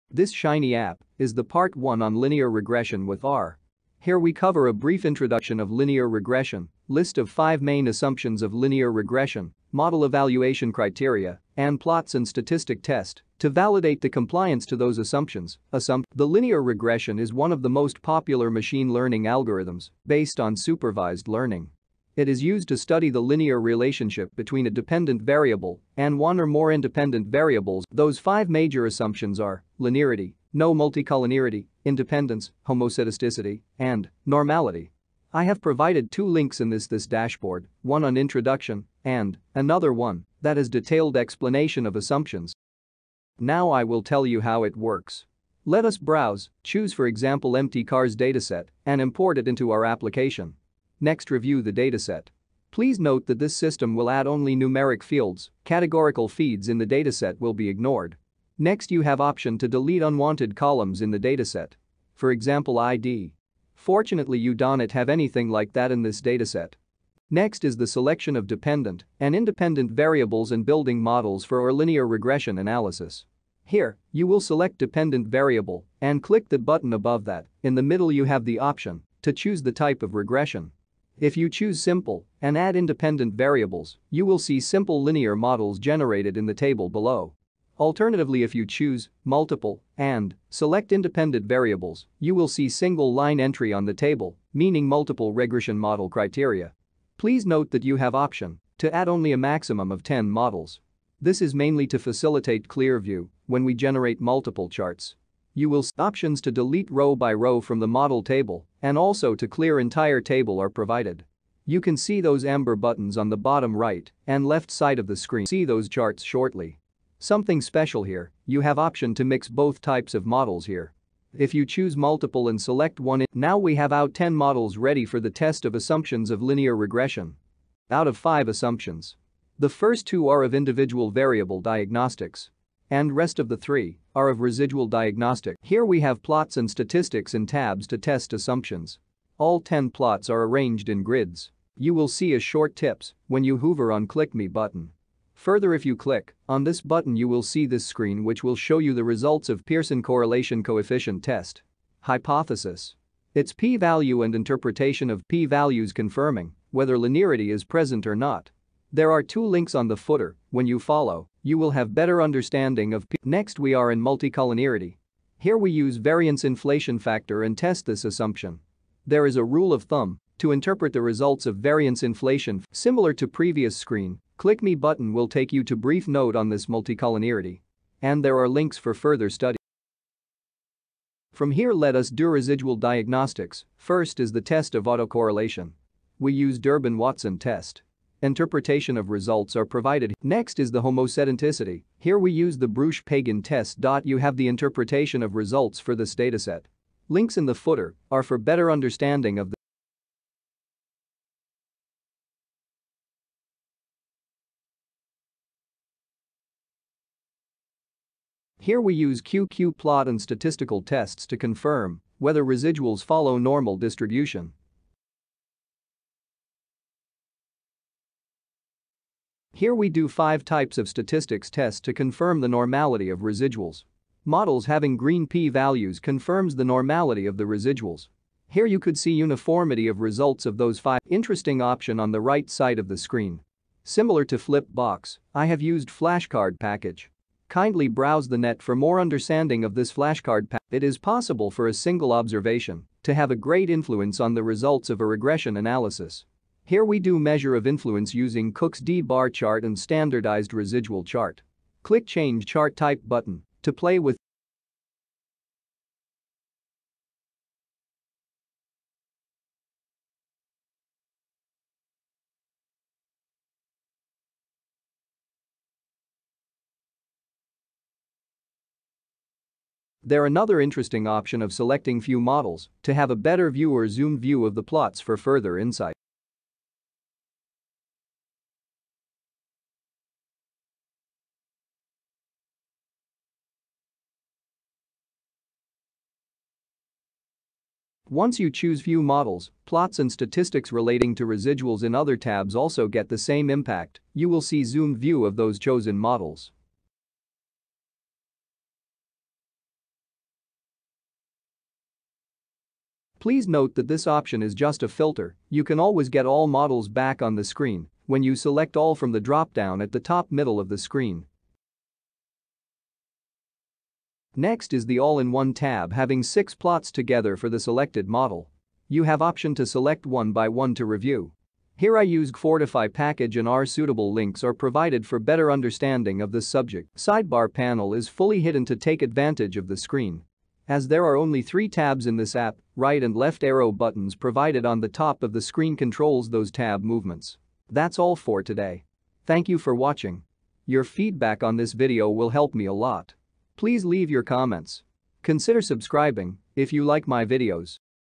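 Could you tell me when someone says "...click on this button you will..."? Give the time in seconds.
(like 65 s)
145 s.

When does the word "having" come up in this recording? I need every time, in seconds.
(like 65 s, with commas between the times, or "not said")
224 s, 315 s.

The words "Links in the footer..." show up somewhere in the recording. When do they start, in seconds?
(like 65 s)
197 s.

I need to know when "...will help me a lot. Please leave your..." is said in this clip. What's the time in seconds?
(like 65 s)
342 s.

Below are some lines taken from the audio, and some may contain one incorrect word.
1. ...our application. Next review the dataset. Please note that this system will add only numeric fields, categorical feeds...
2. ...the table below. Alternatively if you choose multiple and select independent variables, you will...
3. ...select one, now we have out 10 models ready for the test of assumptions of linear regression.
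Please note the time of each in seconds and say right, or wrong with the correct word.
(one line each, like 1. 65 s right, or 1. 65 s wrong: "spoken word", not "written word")
1. 49 s right
2. 86 s right
3. 122 s right.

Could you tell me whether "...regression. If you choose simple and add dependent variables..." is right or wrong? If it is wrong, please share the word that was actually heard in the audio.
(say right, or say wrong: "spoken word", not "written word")
wrong: "independent", not "dependent".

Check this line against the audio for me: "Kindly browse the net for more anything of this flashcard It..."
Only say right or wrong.
wrong.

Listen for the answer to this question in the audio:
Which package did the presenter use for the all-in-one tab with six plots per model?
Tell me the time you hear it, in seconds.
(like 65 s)
322 s.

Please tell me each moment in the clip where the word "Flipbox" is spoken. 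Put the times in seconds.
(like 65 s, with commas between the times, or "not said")
234 s.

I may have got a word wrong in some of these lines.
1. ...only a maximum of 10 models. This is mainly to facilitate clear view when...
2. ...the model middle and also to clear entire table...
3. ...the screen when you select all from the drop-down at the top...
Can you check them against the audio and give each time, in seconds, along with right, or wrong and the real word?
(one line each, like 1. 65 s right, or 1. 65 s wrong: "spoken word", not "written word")
1. 99 s right
2. 107 s wrong: "table", not "middle"
3. 307 s right.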